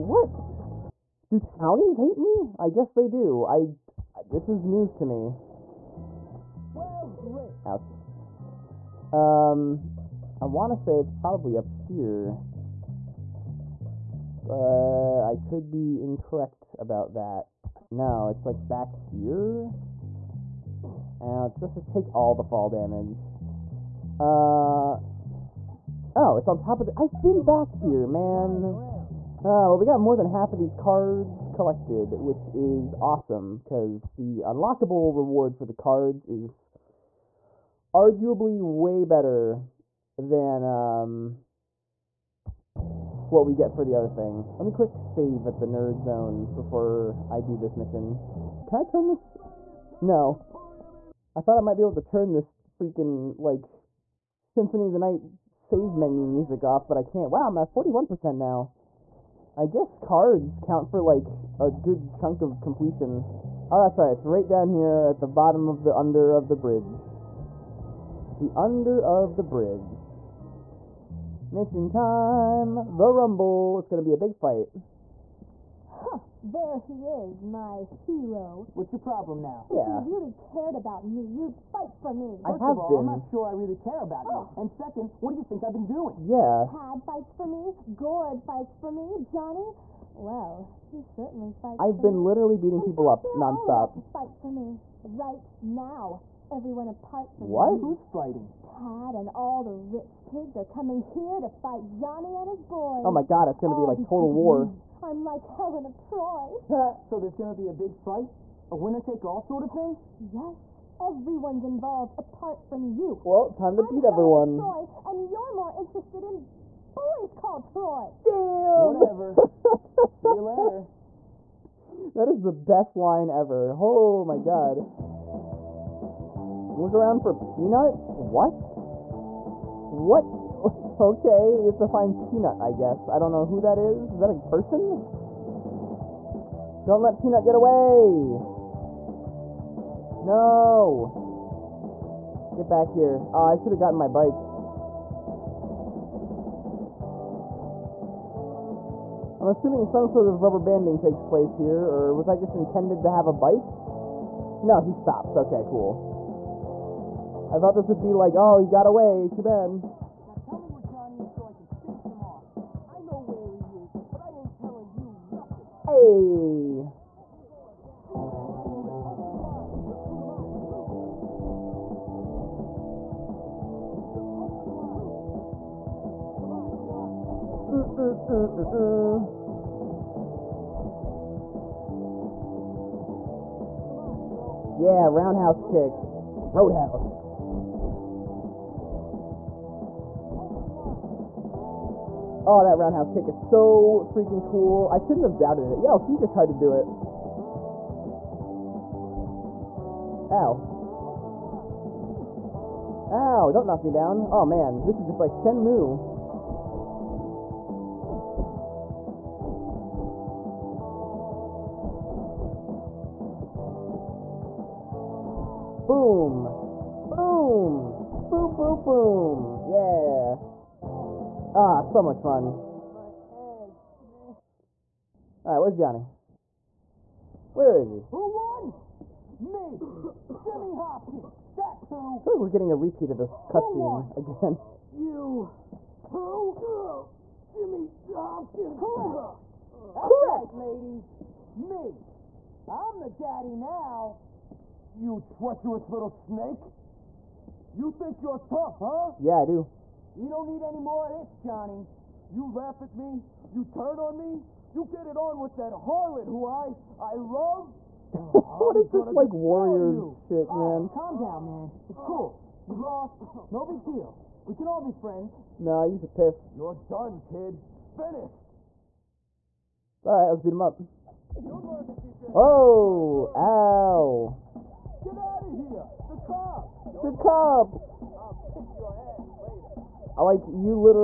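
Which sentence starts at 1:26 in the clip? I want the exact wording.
Tad fights for me, Gord fights for me, Johnny.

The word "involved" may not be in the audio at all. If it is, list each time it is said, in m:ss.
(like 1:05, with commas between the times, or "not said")
1:51.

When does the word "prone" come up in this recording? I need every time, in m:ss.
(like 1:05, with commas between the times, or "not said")
not said.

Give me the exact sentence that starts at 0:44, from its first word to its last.
Let me quick save at the nerd zone before I do this mission.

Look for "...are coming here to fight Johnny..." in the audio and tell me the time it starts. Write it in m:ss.
1:40.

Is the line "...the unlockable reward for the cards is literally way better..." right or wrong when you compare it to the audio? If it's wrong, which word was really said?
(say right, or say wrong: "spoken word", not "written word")
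wrong: "arguably", not "literally".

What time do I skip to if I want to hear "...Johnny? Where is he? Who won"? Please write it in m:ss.
3:45.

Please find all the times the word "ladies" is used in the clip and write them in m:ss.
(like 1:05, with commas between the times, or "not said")
4:00.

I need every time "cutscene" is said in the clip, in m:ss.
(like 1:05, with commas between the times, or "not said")
3:53.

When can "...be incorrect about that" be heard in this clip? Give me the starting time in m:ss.
0:15.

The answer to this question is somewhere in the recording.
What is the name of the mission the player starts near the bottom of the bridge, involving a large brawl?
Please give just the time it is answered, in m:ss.
1:12.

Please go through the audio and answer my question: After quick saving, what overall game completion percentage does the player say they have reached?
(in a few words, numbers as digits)
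41%.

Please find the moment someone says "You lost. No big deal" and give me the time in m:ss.
4:22.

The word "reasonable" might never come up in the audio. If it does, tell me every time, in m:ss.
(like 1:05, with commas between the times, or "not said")
not said.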